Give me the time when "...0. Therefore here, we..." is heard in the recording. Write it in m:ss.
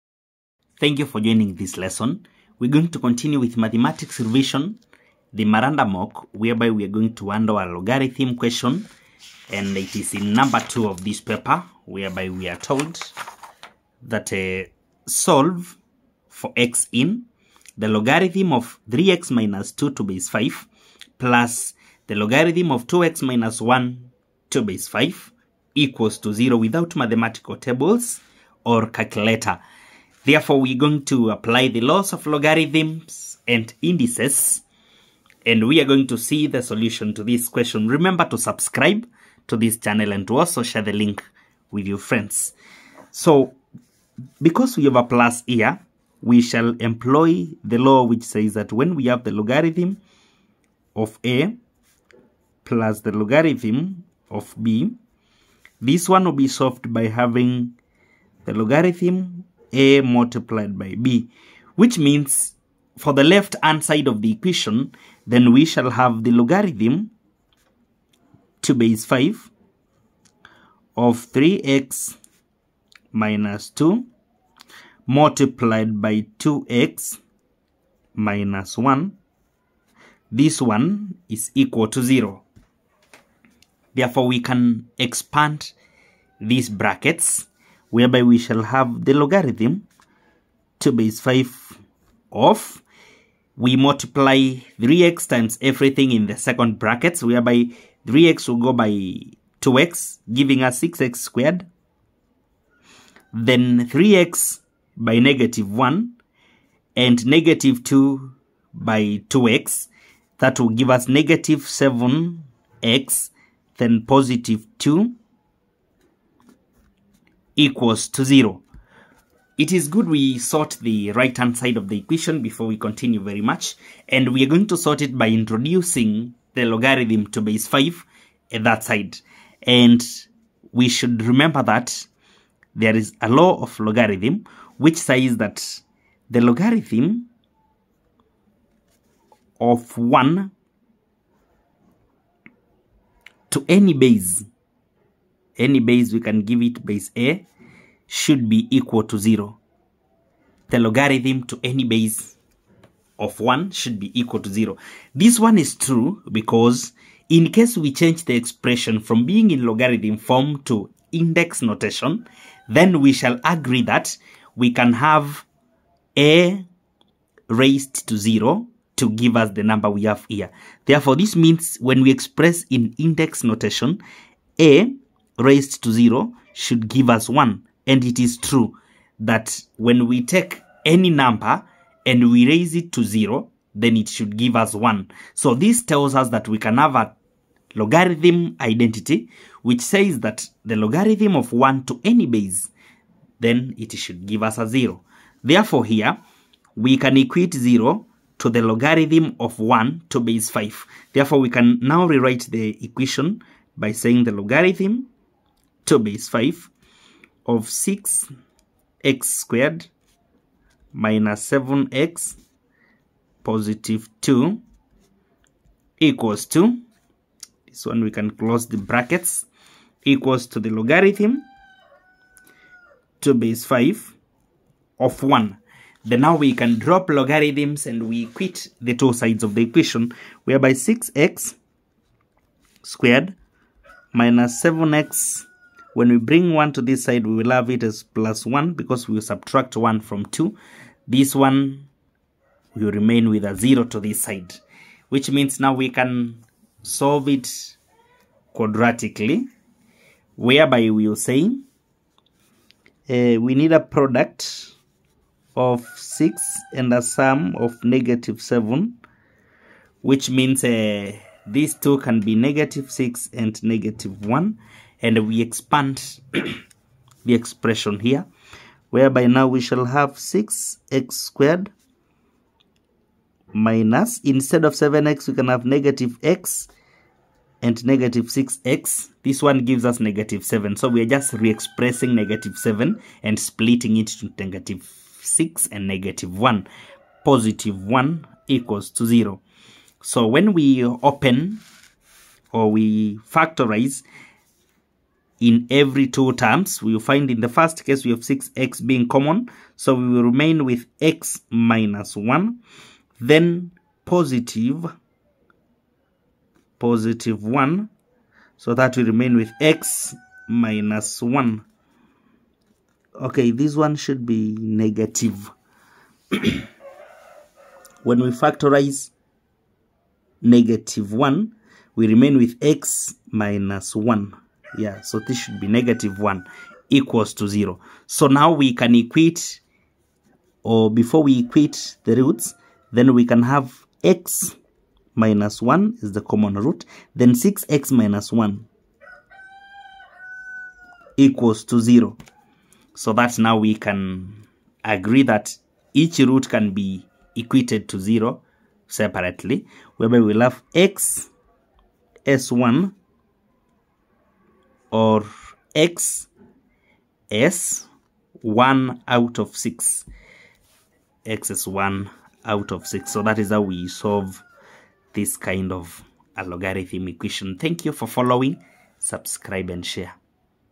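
3:14.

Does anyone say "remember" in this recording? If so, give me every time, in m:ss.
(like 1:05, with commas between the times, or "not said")
0:37, 2:11.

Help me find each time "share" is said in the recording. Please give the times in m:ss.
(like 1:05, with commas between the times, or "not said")
0:40, 6:09.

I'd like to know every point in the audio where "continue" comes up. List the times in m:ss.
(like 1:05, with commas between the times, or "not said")
0:02, 2:02.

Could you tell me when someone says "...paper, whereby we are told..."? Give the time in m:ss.
0:11.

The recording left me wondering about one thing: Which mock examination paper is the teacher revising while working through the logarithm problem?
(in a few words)
Maranda mock.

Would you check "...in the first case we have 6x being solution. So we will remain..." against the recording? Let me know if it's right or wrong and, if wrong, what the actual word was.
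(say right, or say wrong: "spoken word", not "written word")
wrong: "common", not "solution".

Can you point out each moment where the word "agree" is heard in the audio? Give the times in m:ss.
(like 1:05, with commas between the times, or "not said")
2:43, 5:44.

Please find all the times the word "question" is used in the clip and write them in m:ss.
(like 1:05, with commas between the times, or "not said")
0:08, 0:37.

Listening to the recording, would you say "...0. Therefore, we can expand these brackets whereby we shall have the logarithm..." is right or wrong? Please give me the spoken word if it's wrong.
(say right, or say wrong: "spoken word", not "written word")
right.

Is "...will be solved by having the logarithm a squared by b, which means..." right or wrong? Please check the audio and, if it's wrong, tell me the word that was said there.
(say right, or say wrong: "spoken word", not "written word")
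wrong: "multiplied", not "squared".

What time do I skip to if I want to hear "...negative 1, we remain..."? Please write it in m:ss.
5:20.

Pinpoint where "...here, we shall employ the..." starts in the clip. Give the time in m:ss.
0:45.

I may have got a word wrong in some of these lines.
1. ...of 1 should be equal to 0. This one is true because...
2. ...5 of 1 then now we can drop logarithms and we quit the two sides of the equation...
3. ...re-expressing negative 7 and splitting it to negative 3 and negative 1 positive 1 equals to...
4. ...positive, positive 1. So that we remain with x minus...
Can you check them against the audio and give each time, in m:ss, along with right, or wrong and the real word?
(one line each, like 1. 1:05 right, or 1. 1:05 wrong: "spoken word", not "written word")
1. 2:33 right
2. 3:43 right
3. 4:41 wrong: "6", not "3"
4. 5:04 right.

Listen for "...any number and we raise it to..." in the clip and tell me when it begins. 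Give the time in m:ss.
3:00.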